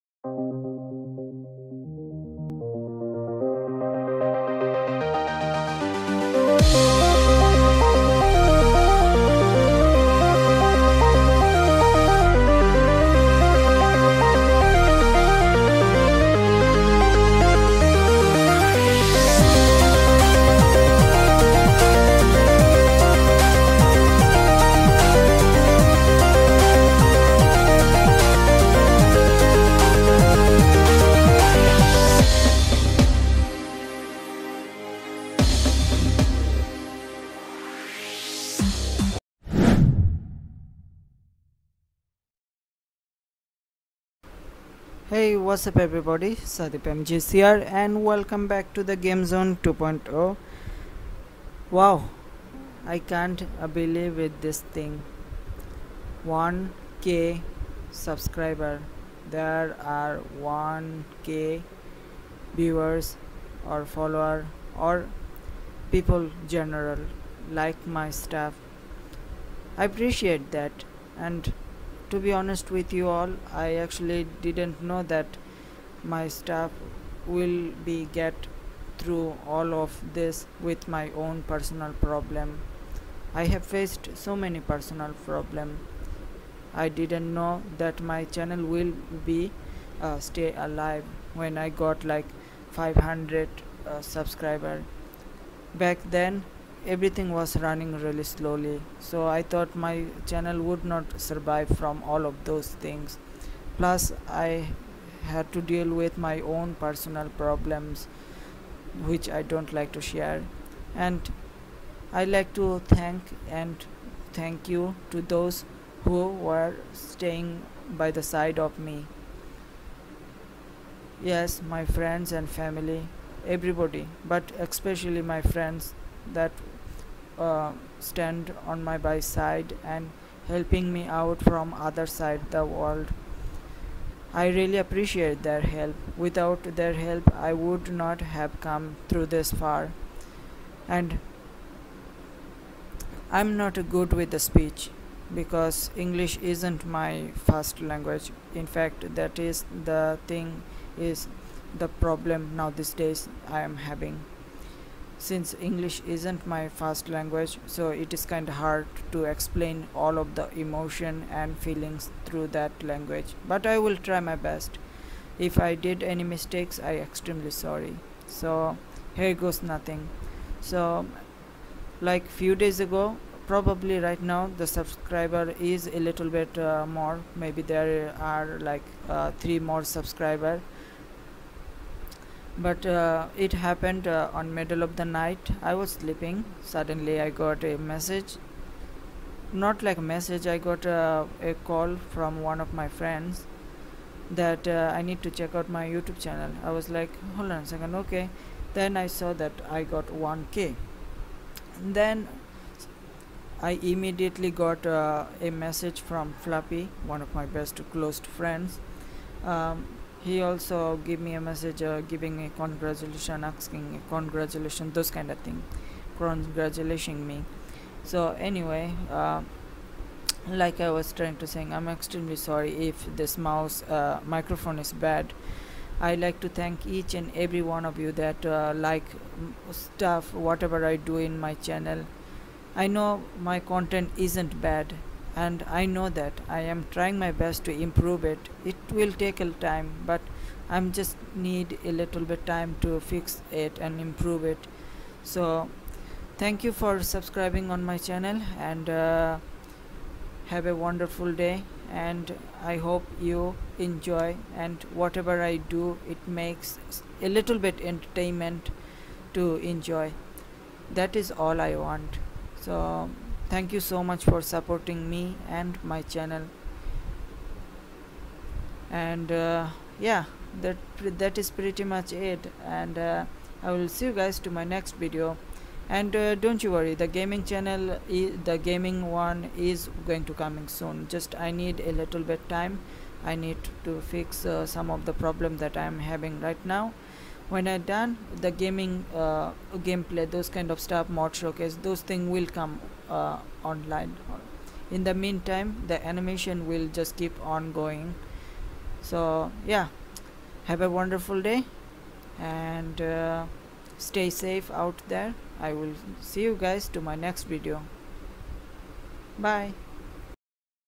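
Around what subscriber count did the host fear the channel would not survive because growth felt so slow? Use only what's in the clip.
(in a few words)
500.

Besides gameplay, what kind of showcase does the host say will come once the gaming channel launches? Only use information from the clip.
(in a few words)
mod showcase.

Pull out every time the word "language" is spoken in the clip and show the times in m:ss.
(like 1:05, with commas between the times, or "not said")
2:27, 2:37, 2:42.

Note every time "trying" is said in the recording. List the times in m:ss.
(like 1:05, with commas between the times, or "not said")
3:41, 3:56.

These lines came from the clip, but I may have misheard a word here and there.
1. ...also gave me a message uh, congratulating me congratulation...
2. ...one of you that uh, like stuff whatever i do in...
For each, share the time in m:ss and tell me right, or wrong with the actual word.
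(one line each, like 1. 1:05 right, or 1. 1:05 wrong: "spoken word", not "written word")
1. 3:30 wrong: "giving", not "congratulating"
2. 3:47 right.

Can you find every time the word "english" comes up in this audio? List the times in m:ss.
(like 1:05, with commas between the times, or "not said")
2:25, 2:35.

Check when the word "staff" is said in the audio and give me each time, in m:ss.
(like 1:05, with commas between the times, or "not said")
1:08, 1:16.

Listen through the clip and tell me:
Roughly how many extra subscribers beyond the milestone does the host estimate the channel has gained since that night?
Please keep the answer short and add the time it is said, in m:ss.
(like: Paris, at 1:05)
3, at 2:59.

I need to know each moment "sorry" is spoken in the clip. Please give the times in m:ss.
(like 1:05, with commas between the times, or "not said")
2:47, 3:42.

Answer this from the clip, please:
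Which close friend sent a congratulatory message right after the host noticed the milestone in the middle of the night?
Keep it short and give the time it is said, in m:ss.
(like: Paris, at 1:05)
Flappy, at 3:26.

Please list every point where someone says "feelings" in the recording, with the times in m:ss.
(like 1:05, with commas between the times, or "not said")
2:41.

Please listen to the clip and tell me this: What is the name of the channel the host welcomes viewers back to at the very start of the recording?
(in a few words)
the game zone 2.0.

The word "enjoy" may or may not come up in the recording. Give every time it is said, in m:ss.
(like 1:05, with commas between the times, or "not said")
4:13, 4:19.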